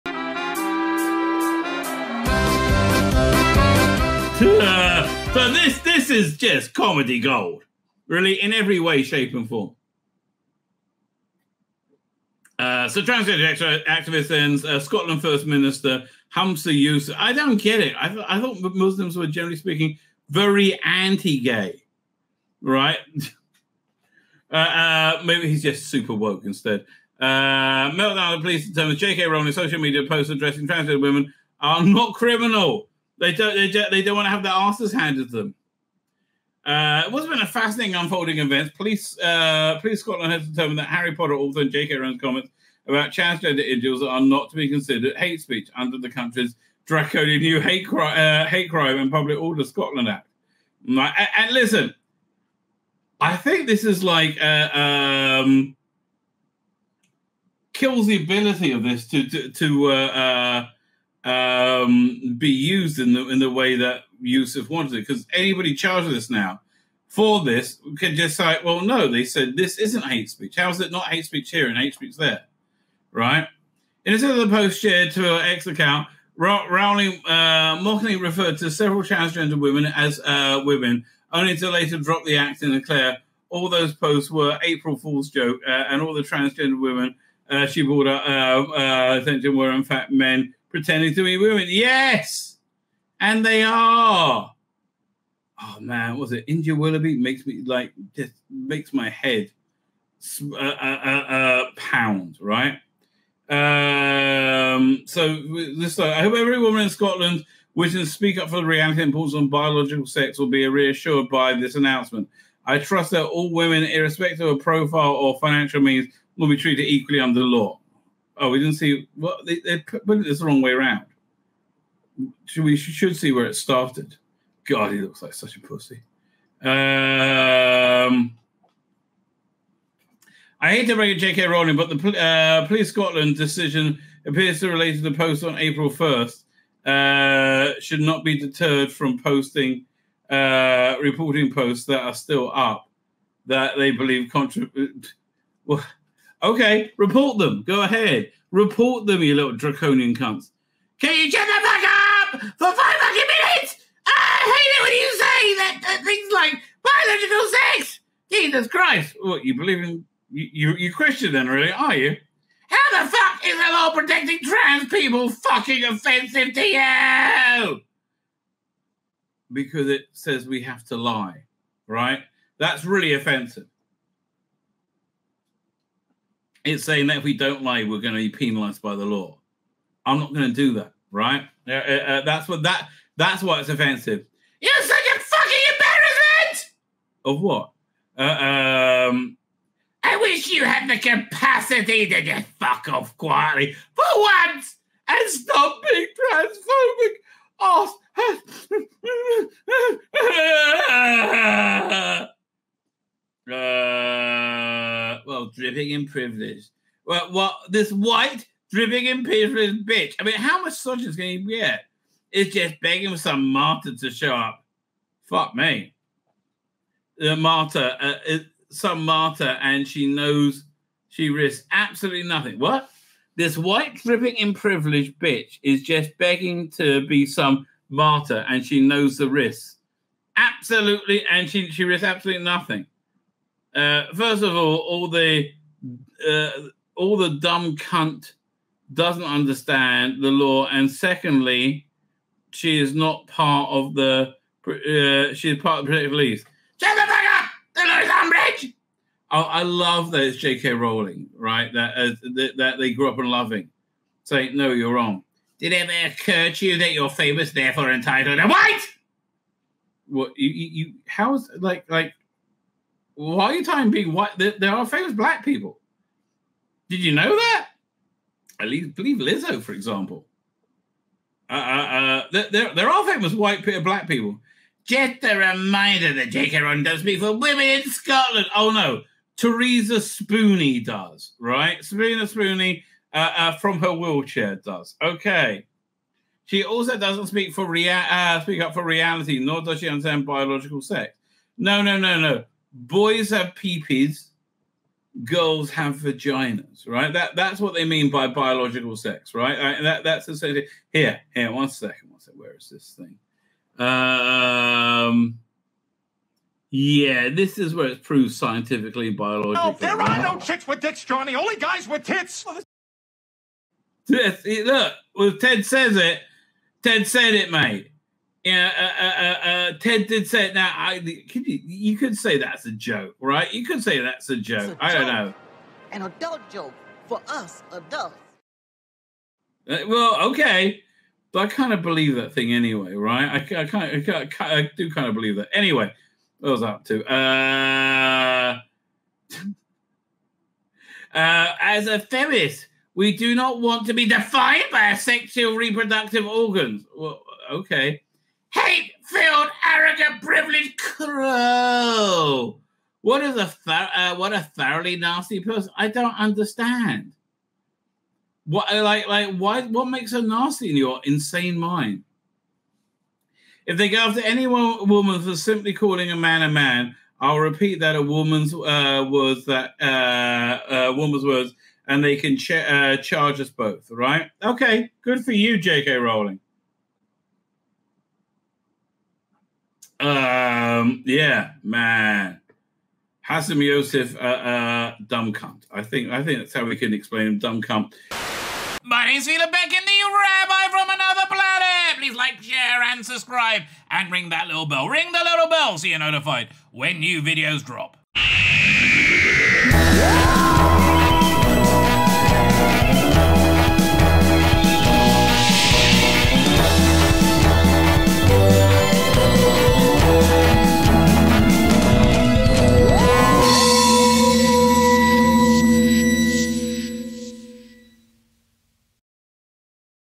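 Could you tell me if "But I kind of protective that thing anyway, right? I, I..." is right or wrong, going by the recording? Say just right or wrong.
wrong.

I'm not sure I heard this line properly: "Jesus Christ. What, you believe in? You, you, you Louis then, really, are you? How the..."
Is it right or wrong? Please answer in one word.
wrong.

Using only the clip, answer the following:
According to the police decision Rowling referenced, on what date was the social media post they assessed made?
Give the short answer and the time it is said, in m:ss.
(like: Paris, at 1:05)
April 1st, at 2:15.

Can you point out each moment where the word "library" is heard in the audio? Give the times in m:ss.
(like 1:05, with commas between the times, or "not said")
not said.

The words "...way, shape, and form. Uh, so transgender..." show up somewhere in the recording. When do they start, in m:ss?
0:08.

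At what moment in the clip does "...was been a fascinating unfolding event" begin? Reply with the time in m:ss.
0:37.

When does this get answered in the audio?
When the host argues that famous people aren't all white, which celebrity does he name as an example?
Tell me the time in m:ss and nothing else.
4:29.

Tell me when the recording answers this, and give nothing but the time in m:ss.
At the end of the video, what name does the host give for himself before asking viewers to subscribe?
6:29.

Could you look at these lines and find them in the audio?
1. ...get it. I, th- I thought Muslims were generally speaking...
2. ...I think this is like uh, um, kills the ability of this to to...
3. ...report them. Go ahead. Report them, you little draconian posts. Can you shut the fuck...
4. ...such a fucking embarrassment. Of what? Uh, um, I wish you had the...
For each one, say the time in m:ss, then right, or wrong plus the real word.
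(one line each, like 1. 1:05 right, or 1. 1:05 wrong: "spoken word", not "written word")
1. 0:17 right
2. 0:53 right
3. 2:26 wrong: "cunts", not "posts"
4. 3:04 right.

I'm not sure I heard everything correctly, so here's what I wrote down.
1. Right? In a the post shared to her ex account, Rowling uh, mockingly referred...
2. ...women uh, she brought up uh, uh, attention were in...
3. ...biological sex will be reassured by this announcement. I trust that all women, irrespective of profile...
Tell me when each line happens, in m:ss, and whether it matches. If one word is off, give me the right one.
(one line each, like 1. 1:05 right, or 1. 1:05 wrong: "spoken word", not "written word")
1. 1:13 right
2. 1:26 right
3. 1:49 right.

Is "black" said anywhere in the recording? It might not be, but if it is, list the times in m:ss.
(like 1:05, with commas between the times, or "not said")
4:25, 4:33.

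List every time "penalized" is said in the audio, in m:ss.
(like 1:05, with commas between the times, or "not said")
2:58.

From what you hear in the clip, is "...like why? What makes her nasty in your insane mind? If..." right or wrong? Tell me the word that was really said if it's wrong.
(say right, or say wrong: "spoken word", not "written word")
right.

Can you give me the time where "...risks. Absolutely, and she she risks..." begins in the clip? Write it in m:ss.
3:49.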